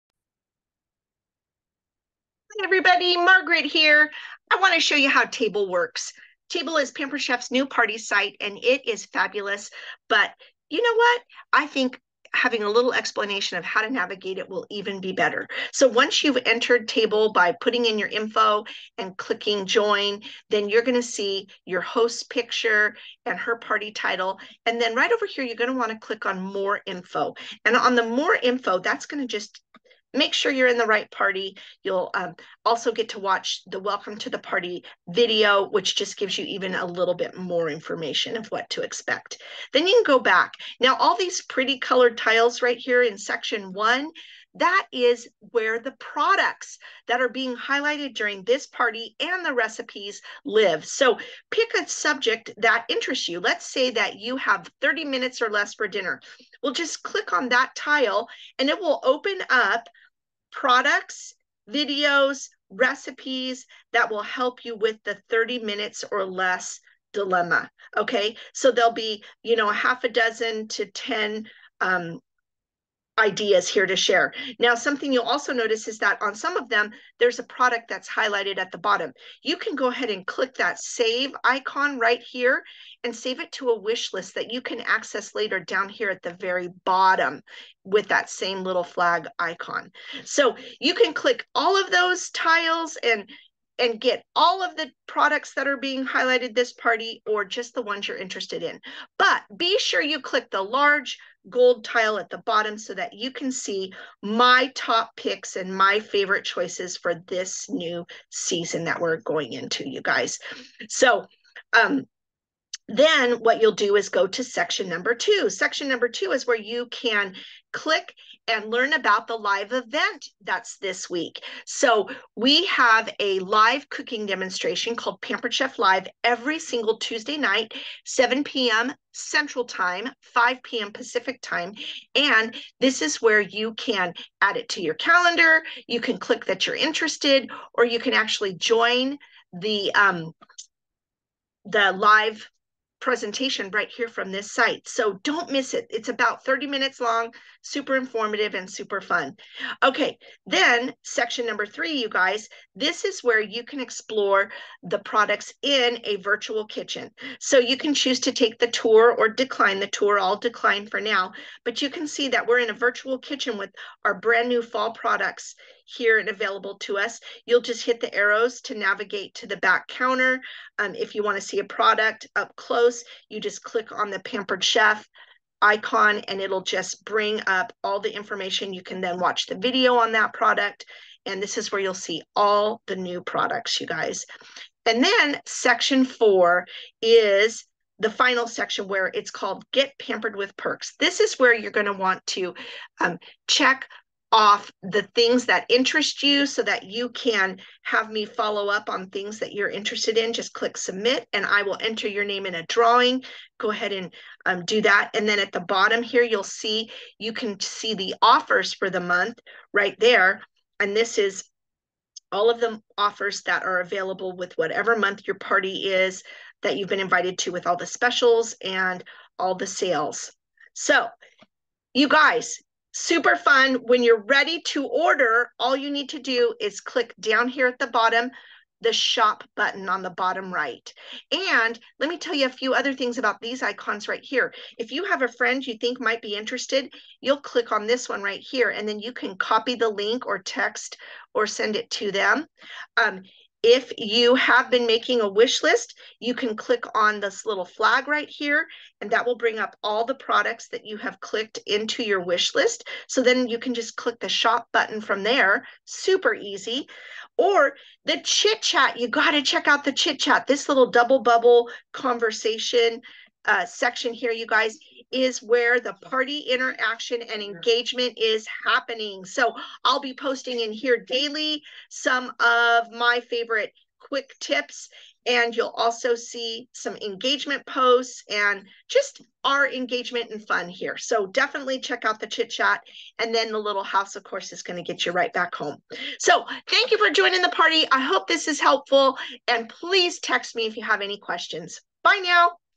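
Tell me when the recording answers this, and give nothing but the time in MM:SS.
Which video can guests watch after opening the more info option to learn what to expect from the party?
00:33.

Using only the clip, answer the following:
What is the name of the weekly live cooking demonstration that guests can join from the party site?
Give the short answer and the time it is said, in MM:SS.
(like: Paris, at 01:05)
Pampered Chef Live, at 02:05.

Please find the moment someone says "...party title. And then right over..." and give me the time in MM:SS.
00:23.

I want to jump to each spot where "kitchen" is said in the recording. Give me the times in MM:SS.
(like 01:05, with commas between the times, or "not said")
02:36, 02:43.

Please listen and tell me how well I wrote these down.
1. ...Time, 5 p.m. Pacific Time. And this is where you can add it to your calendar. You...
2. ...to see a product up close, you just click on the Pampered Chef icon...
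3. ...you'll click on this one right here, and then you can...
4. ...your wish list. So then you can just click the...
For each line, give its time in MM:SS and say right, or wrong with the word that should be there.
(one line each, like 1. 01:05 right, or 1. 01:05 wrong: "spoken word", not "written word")
1. 02:09 right
2. 02:51 right
3. 03:57 right
4. 04:12 right.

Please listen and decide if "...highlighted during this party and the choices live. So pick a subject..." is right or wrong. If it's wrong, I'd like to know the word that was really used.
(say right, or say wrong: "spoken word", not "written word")
wrong: "recipes", not "choices".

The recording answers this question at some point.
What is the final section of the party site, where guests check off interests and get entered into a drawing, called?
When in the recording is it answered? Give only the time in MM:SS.
03:09.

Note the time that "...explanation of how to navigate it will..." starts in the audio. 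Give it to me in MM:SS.
00:12.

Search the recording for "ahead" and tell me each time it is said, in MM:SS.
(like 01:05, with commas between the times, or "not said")
01:19, 03:23.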